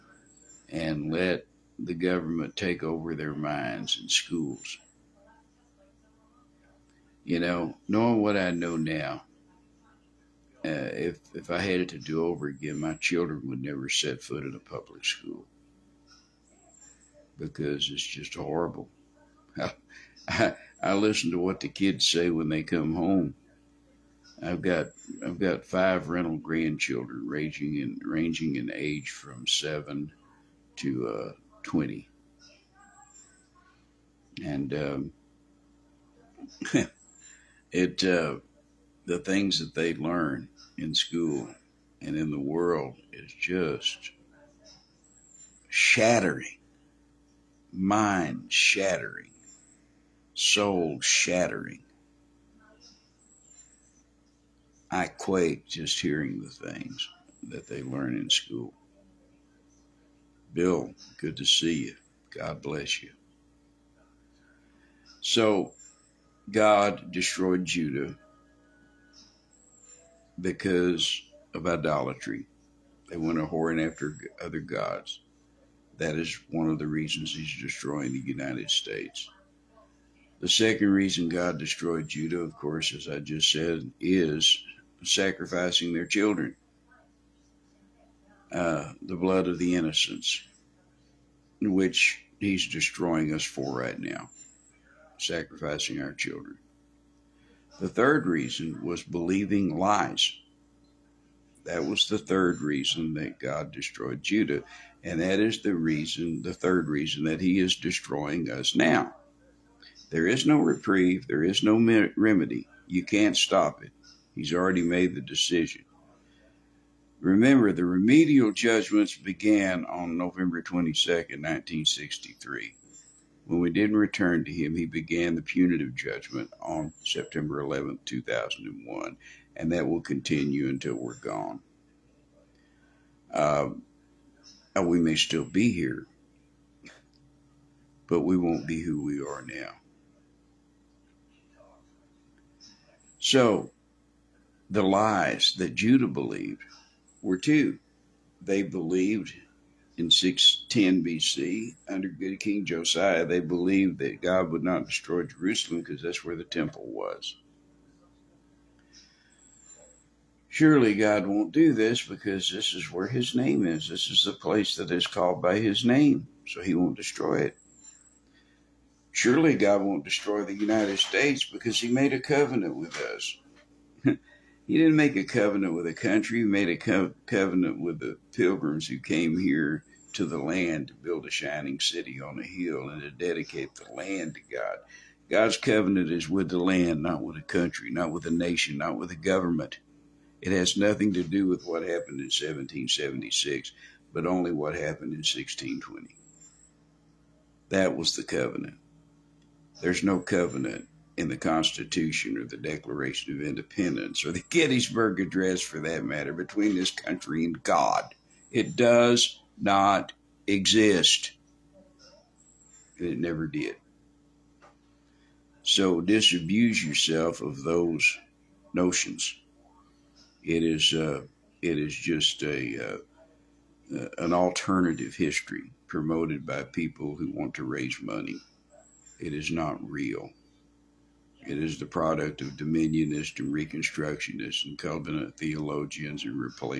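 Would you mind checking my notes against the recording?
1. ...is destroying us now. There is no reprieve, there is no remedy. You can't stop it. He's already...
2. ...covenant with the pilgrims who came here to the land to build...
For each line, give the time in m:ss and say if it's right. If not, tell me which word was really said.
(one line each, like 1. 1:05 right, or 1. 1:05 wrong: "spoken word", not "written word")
1. 1:47 right
2. 2:57 right.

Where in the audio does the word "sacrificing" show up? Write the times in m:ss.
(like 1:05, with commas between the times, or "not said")
1:25, 1:35.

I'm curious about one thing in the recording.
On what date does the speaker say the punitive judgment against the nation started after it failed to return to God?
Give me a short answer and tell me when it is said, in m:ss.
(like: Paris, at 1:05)
September 11, 2001, at 2:07.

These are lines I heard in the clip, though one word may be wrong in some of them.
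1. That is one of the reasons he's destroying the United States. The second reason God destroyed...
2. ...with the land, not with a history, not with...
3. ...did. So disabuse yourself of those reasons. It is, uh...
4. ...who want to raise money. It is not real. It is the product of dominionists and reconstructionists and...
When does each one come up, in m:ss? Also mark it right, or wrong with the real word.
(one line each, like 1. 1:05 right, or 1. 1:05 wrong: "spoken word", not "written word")
1. 1:15 right
2. 3:06 wrong: "country", not "history"
3. 3:33 wrong: "notions", not "reasons"
4. 3:47 right.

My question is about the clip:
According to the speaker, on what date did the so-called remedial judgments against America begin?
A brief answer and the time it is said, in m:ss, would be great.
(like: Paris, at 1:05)
November 22, 1963, at 2:00.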